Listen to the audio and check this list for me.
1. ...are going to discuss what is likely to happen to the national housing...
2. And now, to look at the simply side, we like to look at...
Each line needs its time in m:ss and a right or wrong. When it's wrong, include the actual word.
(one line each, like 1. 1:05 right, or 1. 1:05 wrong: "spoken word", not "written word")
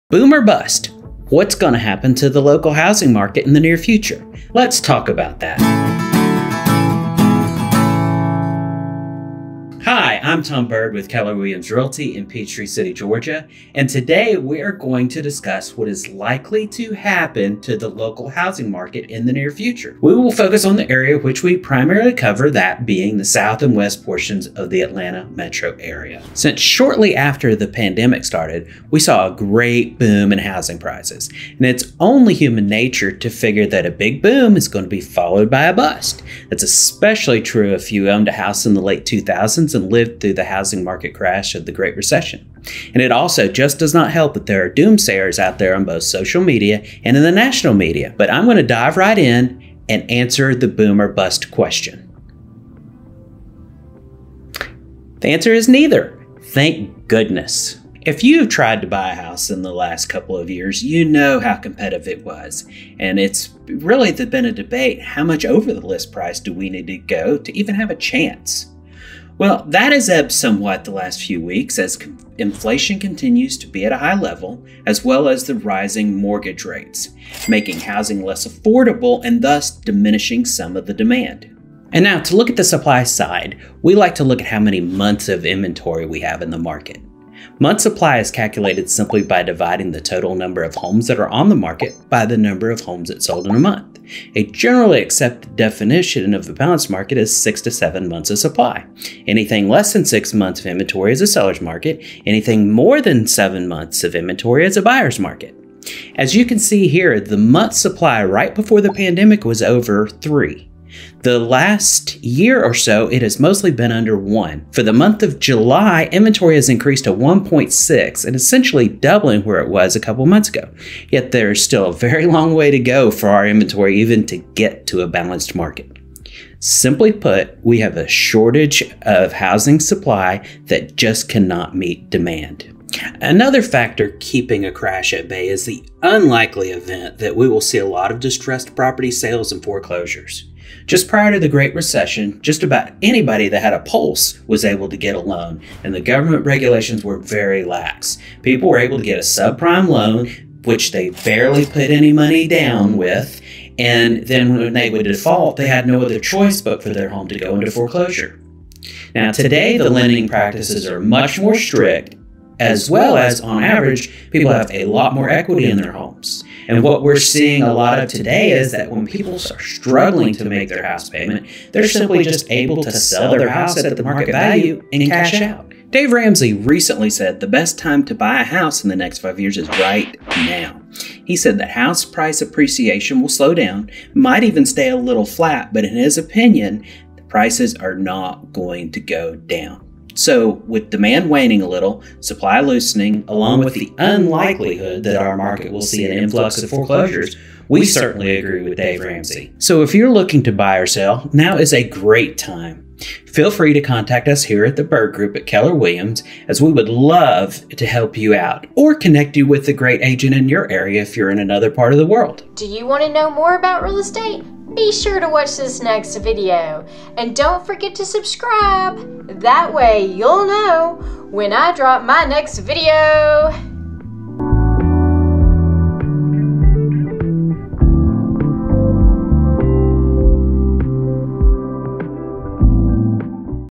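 1. 0:14 wrong: "local", not "national"
2. 1:21 wrong: "supply", not "simply".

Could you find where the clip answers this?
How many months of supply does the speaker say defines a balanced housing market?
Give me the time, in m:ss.
1:37.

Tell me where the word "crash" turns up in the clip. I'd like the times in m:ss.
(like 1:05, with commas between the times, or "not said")
0:41, 2:14.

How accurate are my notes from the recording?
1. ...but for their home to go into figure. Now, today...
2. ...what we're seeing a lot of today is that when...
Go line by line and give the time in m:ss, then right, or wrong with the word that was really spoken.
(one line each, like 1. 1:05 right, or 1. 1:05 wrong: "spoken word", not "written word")
1. 2:36 wrong: "foreclosure", not "figure"
2. 2:46 right.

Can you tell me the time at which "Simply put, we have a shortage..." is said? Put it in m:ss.
2:06.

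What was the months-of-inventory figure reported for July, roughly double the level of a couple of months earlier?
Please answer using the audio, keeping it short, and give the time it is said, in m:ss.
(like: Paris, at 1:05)
1.6, at 1:57.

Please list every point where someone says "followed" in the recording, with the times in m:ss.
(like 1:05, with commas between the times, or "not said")
0:35.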